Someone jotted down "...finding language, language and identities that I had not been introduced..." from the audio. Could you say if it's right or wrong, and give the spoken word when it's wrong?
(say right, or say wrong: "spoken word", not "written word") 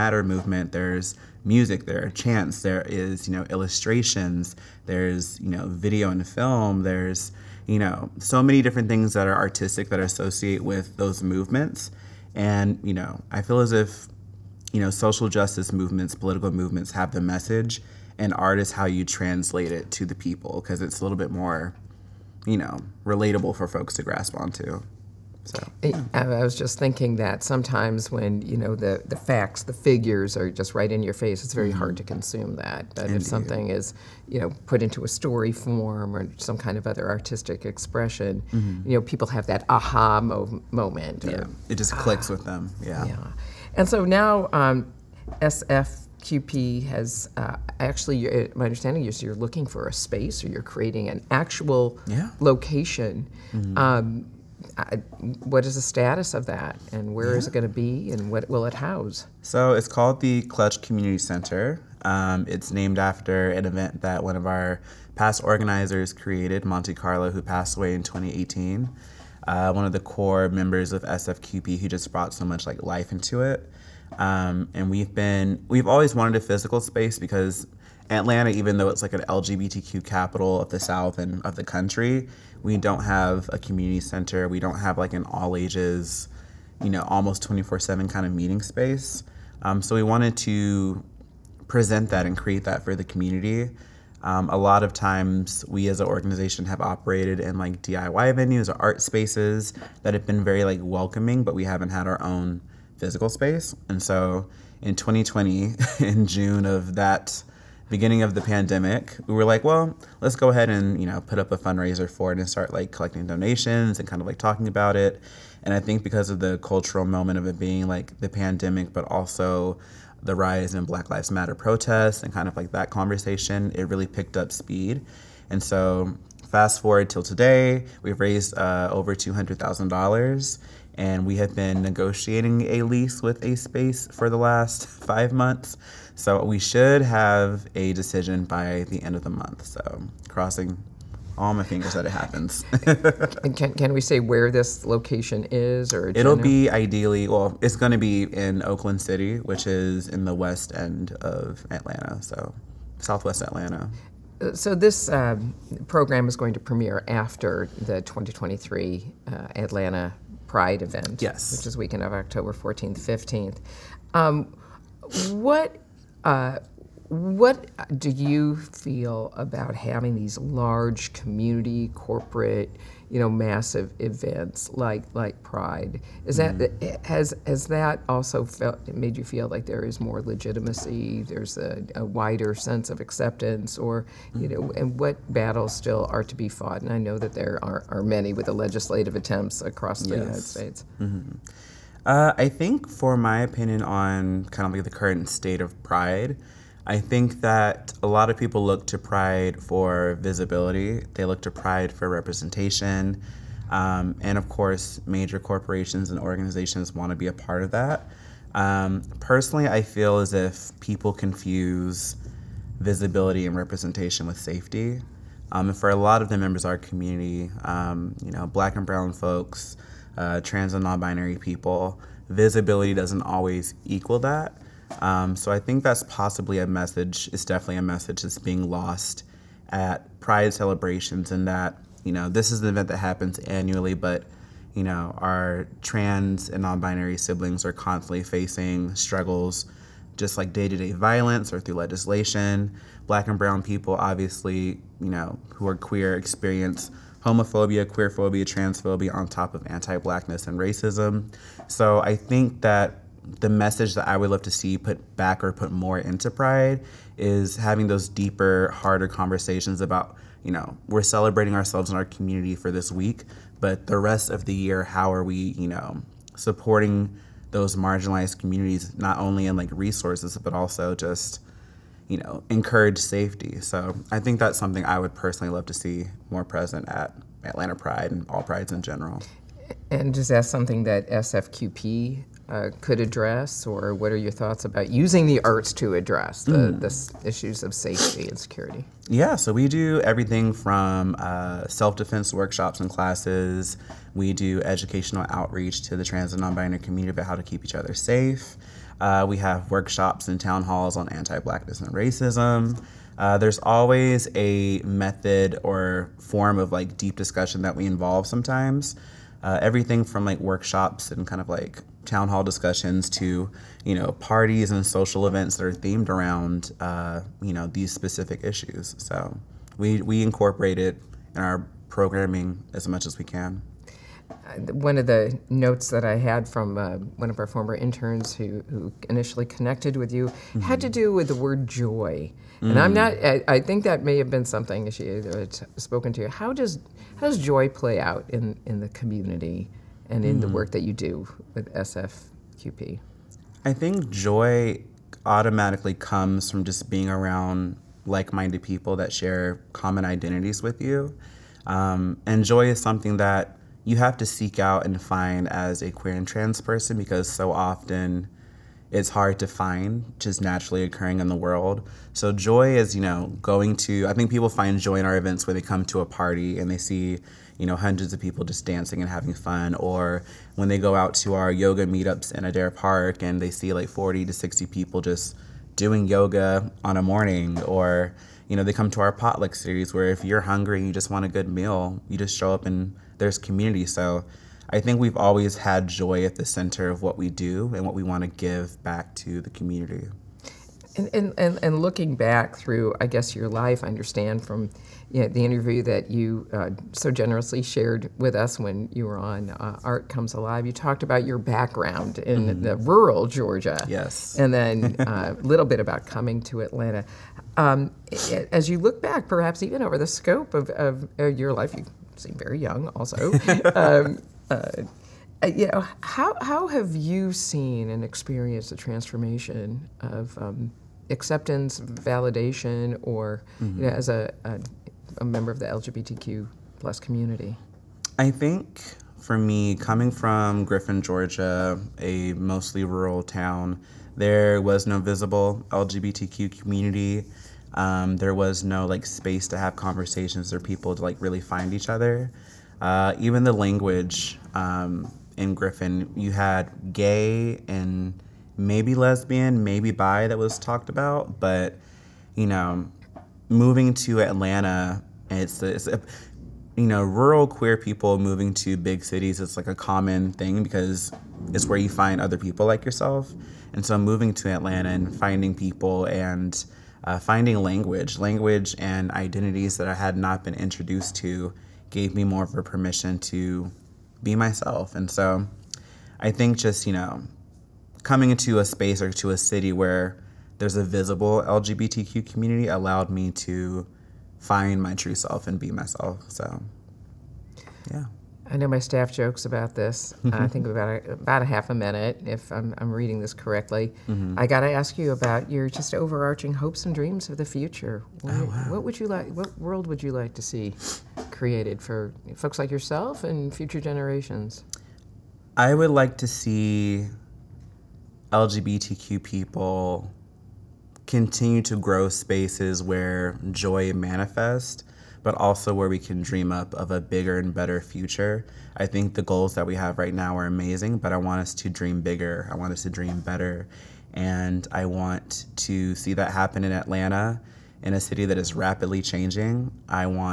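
right.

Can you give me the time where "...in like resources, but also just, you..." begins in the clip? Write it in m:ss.
4:29.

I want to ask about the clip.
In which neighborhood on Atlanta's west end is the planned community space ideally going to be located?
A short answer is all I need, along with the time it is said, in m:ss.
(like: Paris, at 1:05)
Oakland City, at 2:28.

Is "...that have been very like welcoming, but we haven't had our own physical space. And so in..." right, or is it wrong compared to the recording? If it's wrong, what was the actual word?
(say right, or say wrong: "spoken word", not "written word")
right.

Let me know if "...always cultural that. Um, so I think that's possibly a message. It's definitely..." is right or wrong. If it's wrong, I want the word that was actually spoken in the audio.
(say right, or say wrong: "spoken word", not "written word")
wrong: "equal", not "cultural".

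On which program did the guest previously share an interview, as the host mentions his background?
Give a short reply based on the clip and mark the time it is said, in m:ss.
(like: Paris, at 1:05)
Art Comes Alive, at 6:39.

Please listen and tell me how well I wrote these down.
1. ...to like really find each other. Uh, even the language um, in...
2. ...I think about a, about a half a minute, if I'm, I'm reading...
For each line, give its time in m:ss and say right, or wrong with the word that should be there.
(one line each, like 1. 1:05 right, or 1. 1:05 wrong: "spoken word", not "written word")
1. 7:20 right
2. 8:10 right.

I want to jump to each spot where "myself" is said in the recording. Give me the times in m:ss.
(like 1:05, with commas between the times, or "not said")
7:54, 8:05.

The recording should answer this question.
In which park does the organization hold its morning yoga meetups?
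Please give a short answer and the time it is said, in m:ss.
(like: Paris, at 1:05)
Adair Park, at 6:12.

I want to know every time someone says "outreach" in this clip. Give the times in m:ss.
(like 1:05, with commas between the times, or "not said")
4:55.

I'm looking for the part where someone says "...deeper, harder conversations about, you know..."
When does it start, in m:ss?
4:18.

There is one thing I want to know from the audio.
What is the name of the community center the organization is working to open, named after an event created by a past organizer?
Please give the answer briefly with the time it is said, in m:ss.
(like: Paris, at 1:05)
Clutch Community Center, at 1:00.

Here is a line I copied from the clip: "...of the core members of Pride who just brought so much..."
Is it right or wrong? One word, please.
wrong.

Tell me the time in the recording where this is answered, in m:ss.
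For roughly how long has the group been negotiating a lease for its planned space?
2:14.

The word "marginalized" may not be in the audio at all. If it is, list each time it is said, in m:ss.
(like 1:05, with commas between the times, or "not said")
4:27.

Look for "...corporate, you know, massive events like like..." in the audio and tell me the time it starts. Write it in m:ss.
2:51.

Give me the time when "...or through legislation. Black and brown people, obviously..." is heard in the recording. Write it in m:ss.
4:01.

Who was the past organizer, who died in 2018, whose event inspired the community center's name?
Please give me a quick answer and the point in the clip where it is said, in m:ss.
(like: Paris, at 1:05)
Monte Carlo, at 1:06.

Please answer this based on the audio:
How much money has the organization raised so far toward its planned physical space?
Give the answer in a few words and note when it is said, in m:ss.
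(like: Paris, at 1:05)
over $200,000, at 2:08.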